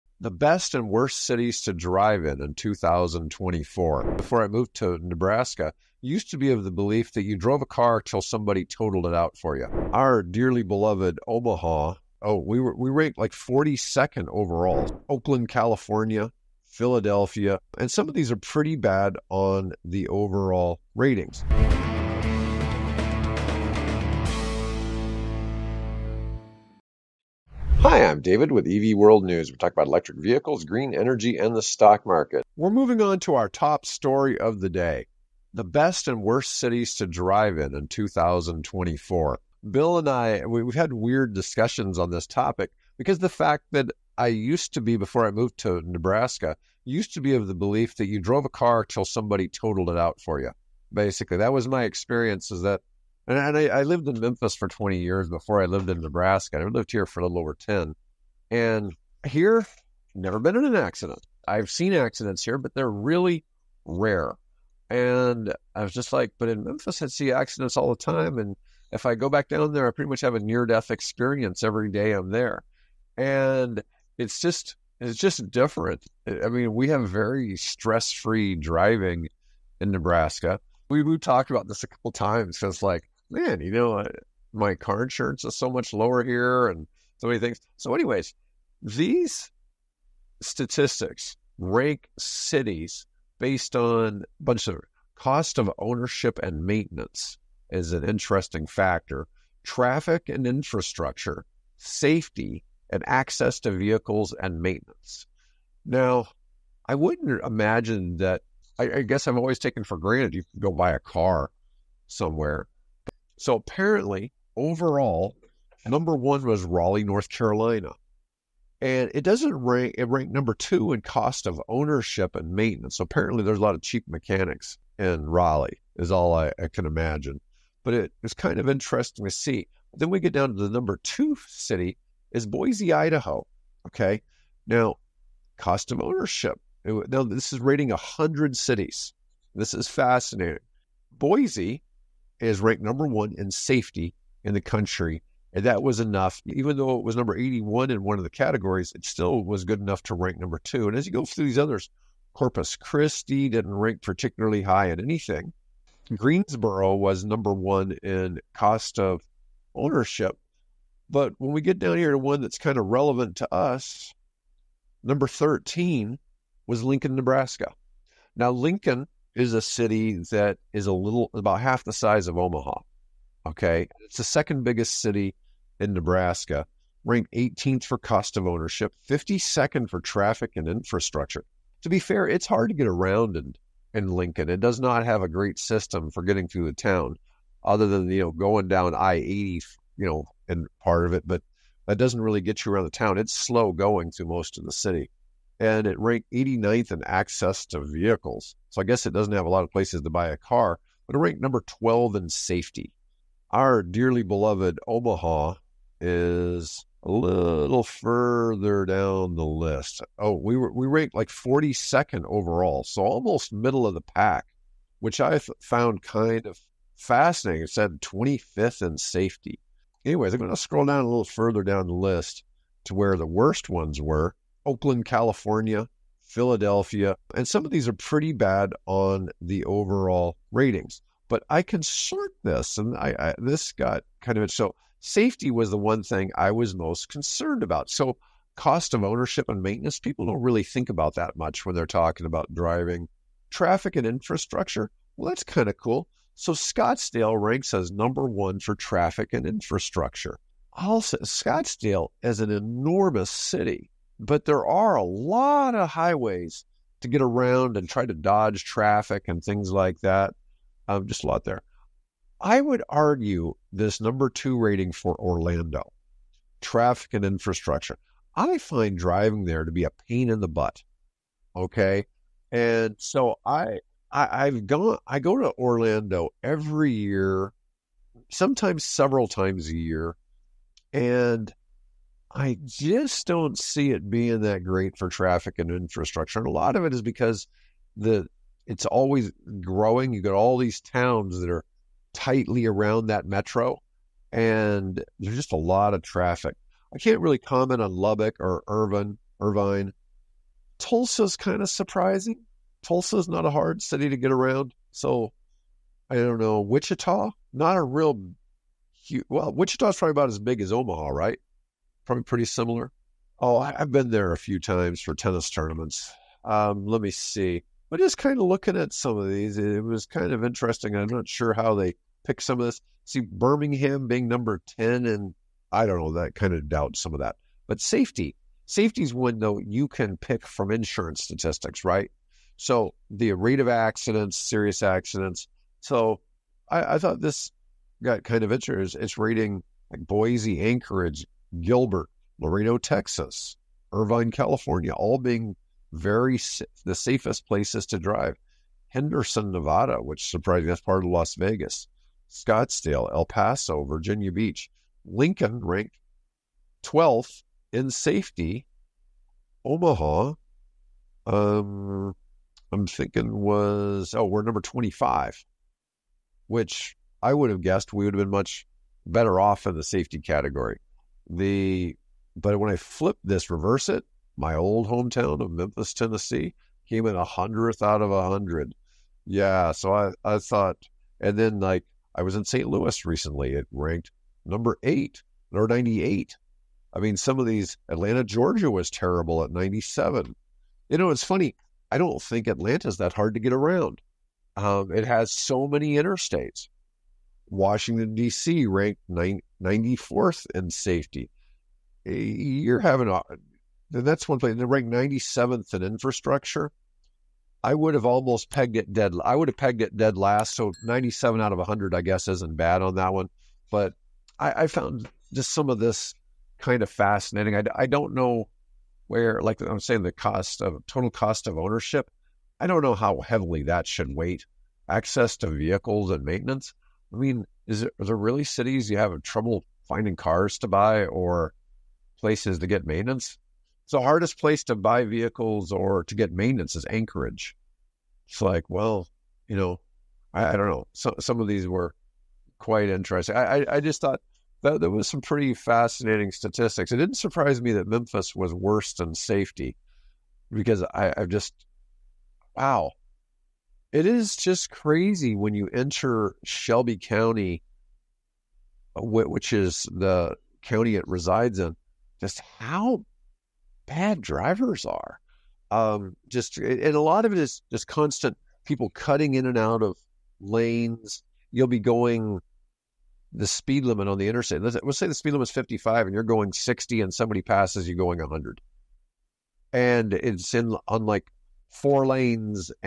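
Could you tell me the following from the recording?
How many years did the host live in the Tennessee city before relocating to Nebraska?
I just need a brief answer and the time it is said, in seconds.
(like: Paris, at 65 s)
20, at 54 s.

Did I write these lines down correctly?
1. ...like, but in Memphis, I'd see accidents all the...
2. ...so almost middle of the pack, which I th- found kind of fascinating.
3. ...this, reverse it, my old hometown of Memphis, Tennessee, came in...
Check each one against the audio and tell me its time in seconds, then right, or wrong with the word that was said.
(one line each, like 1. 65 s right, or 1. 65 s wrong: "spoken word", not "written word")
1. 66 s right
2. 212 s right
3. 373 s right.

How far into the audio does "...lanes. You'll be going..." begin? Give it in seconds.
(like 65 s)
470 s.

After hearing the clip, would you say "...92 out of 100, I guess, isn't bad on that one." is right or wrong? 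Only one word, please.
wrong.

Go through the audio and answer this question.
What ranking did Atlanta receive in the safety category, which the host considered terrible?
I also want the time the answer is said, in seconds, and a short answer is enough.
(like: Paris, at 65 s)
97, at 389 s.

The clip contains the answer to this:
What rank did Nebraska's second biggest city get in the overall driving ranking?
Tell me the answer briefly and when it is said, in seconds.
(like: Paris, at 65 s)
13, at 165 s.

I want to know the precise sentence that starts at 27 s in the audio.
Hi, I'm David with EV World News.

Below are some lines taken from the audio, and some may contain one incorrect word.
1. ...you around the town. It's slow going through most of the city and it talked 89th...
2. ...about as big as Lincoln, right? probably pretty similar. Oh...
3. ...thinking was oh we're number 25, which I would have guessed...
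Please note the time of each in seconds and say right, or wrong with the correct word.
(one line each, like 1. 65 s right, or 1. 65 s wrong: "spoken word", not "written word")
1. 192 s wrong: "ranked", not "talked"
2. 310 s wrong: "Omaha", not "Lincoln"
3. 362 s right.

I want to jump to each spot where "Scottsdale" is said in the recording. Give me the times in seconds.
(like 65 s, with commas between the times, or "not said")
246 s, 251 s, 352 s.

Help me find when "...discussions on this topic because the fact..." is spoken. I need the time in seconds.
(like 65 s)
41 s.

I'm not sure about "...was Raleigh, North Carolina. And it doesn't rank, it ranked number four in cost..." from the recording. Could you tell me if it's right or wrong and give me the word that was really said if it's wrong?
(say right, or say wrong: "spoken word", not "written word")
wrong: "two", not "four".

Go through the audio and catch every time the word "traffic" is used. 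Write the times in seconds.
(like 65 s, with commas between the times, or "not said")
99 s, 180 s, 243 s, 248 s, 258 s, 266 s, 285 s, 296 s.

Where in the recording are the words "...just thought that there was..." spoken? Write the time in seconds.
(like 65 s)
443 s.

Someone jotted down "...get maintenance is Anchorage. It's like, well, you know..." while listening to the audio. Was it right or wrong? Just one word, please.
right.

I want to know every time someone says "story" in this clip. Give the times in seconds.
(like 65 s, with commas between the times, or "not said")
33 s.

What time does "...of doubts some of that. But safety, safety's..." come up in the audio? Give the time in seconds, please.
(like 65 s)
326 s.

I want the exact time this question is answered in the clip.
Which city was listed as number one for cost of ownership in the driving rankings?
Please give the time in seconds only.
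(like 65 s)
156 s.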